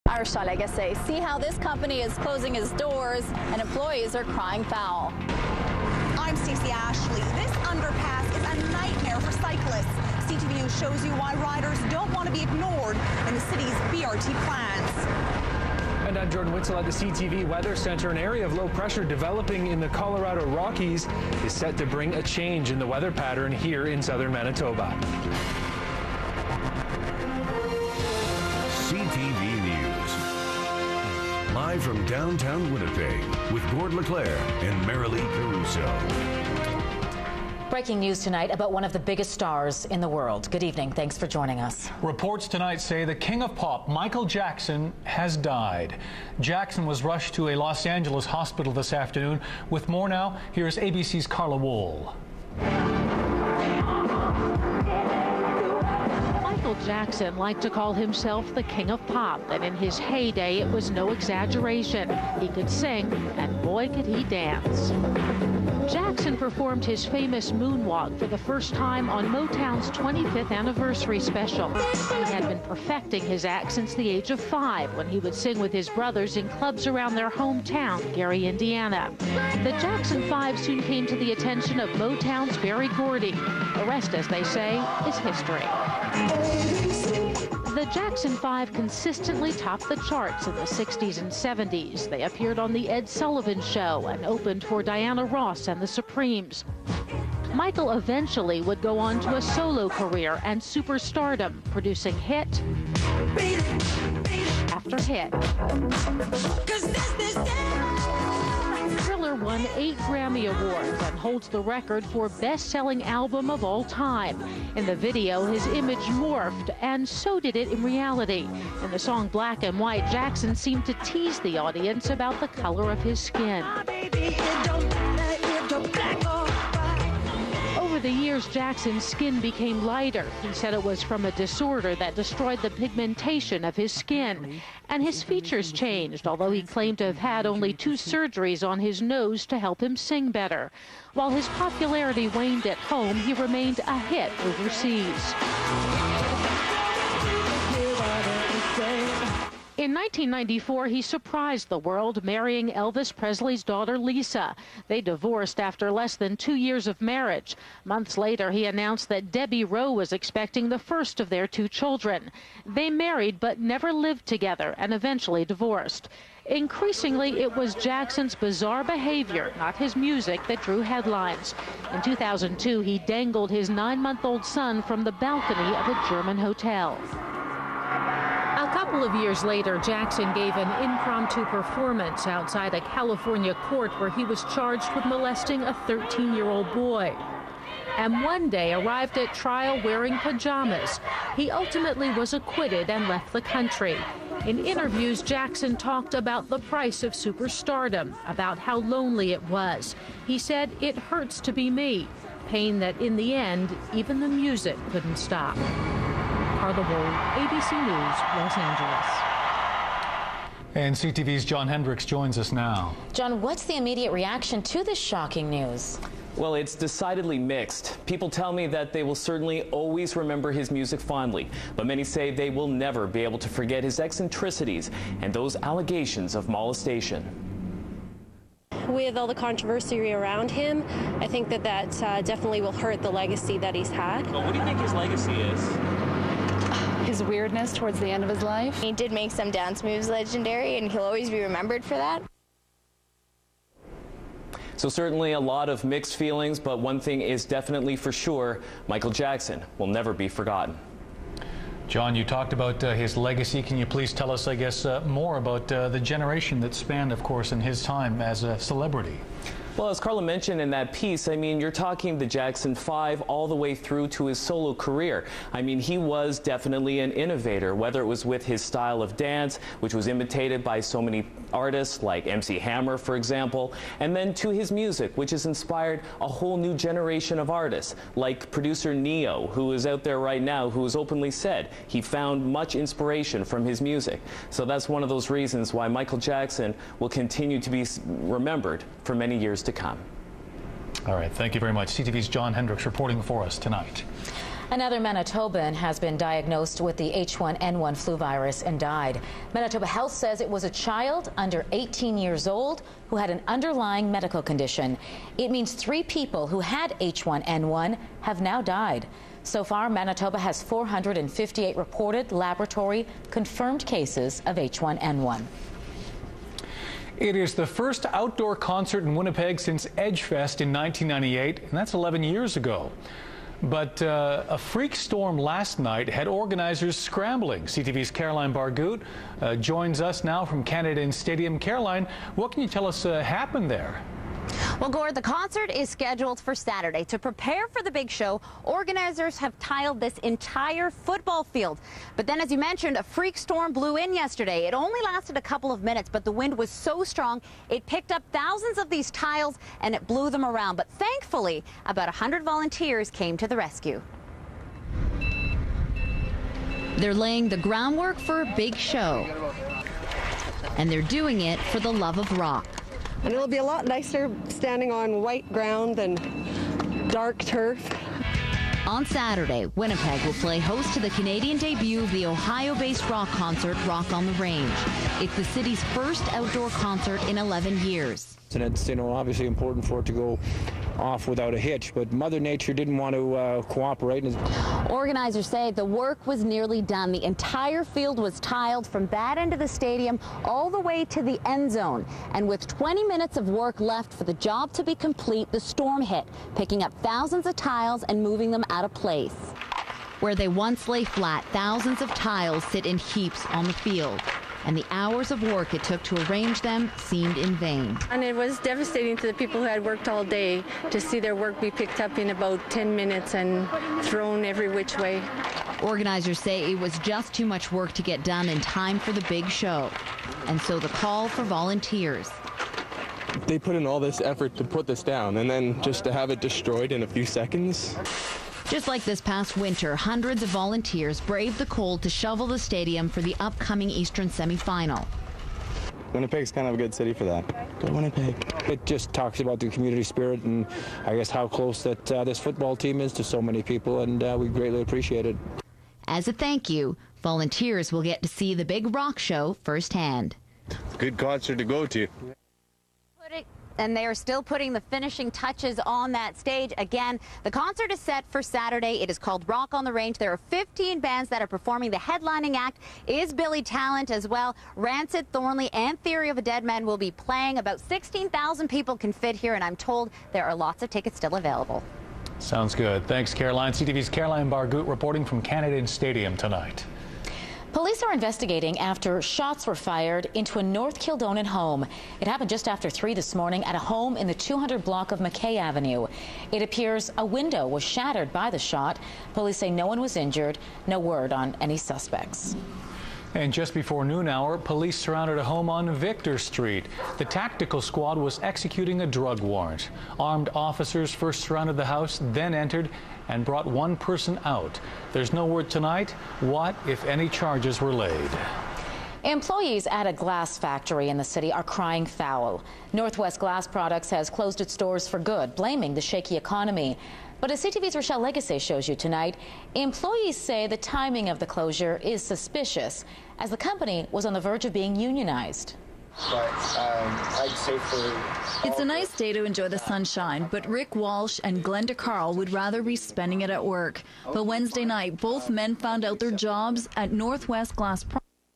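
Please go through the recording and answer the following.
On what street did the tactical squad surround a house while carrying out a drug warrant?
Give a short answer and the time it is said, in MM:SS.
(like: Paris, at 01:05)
Victor Street, at 08:15.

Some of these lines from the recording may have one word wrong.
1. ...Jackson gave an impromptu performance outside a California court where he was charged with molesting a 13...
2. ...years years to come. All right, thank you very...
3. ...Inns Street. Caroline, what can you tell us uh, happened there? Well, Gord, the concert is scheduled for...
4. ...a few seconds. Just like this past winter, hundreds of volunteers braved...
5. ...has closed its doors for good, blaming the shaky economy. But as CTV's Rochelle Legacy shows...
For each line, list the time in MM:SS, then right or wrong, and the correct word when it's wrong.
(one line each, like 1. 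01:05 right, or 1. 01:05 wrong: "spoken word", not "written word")
1. 02:59 right
2. 04:49 right
3. 05:30 wrong: "Stadium", not "Street"
4. 07:07 right
5. 08:34 right.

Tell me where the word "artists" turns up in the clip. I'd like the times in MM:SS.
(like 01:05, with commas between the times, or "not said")
04:31, 04:37.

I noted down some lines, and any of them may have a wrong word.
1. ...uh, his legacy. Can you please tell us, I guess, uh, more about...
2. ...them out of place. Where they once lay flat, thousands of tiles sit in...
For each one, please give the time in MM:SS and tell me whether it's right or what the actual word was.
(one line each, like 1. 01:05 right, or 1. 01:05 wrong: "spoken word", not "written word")
1. 04:12 right
2. 06:38 right.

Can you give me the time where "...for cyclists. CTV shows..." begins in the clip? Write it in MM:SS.
00:09.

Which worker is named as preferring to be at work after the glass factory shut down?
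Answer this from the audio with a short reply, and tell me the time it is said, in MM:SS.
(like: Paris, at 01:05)
Rick Walsh, at 08:50.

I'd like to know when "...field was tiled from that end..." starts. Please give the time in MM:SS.
06:27.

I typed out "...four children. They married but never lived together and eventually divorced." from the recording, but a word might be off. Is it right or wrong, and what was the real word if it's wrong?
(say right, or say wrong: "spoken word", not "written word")
wrong: "two", not "four".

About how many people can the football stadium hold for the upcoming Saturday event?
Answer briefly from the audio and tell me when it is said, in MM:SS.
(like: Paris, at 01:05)
16,000, at 07:47.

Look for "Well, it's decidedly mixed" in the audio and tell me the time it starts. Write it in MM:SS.
03:36.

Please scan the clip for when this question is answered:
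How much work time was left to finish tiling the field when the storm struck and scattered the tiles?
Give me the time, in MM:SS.
06:32.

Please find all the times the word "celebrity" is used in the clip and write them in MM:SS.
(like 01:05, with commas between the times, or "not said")
04:18.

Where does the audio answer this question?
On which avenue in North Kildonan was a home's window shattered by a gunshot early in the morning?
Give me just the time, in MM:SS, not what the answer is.
08:05.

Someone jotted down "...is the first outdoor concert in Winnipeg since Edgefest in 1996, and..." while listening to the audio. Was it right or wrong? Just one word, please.
wrong.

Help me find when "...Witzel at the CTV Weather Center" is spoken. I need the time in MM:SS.
00:16.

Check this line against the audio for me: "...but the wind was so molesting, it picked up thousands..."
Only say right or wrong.
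wrong.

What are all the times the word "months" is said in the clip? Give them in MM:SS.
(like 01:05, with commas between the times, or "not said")
02:37, 02:53.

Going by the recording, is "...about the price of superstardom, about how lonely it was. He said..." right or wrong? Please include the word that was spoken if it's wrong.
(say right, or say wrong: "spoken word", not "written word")
right.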